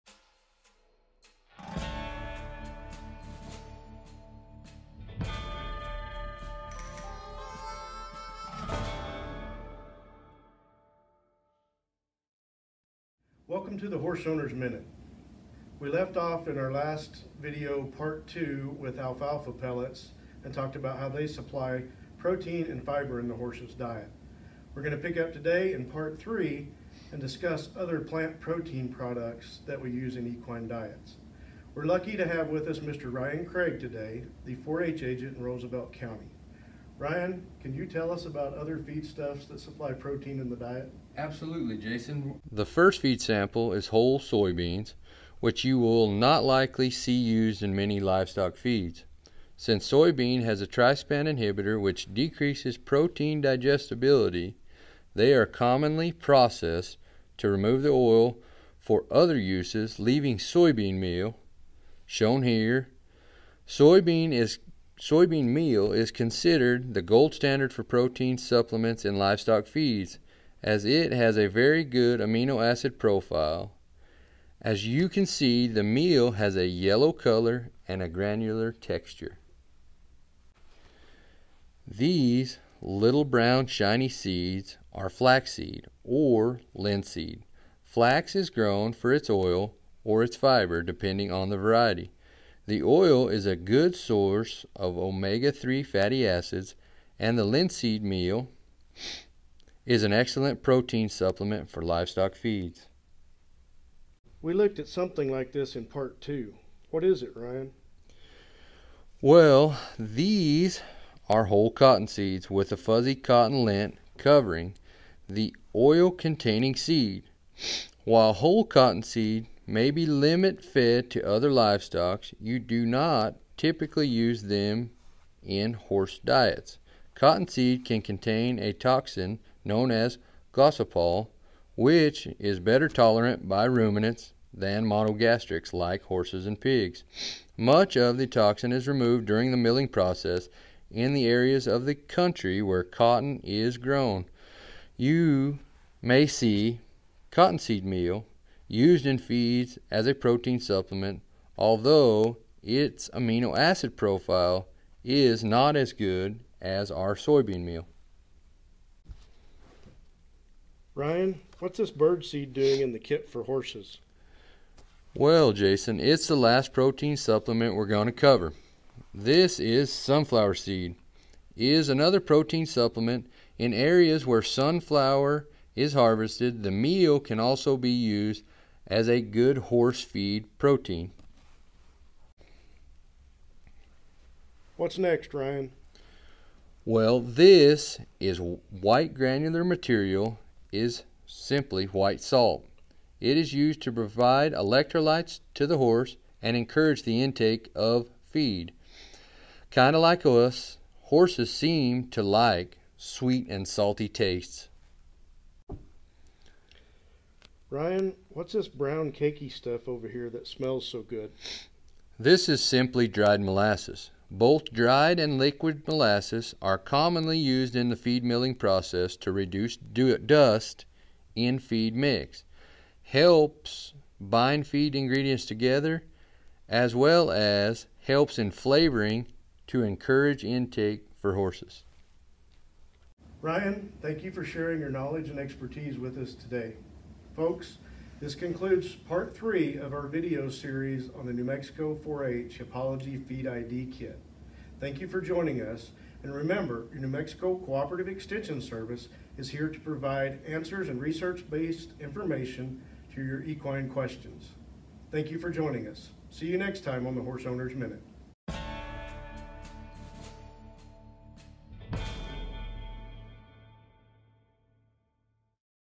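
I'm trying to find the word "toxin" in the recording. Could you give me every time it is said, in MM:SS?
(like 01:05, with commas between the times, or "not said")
02:08, 02:18.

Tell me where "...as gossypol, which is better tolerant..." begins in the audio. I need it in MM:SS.
02:09.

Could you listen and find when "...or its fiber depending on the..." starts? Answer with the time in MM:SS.
01:30.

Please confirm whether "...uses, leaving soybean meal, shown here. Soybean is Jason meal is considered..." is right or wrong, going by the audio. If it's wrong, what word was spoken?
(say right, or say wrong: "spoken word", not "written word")
wrong: "Soybean", not "Jason".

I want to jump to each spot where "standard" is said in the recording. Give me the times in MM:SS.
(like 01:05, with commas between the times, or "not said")
01:07.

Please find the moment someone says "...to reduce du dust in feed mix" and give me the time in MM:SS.
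03:39.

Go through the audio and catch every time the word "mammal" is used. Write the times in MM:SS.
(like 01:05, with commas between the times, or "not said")
not said.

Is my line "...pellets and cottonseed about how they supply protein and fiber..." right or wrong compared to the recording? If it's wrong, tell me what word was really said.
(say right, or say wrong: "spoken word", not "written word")
wrong: "talked", not "cottonseed".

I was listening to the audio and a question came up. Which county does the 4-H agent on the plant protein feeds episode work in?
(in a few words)
Roosevelt County.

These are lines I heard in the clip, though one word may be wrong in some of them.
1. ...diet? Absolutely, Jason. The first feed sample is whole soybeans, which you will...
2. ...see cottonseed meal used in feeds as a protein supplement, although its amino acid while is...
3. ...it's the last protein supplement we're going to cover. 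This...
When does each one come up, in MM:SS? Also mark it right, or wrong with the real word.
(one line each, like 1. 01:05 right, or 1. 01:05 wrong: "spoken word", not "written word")
1. 00:40 right
2. 02:26 wrong: "profile", not "while"
3. 02:45 right.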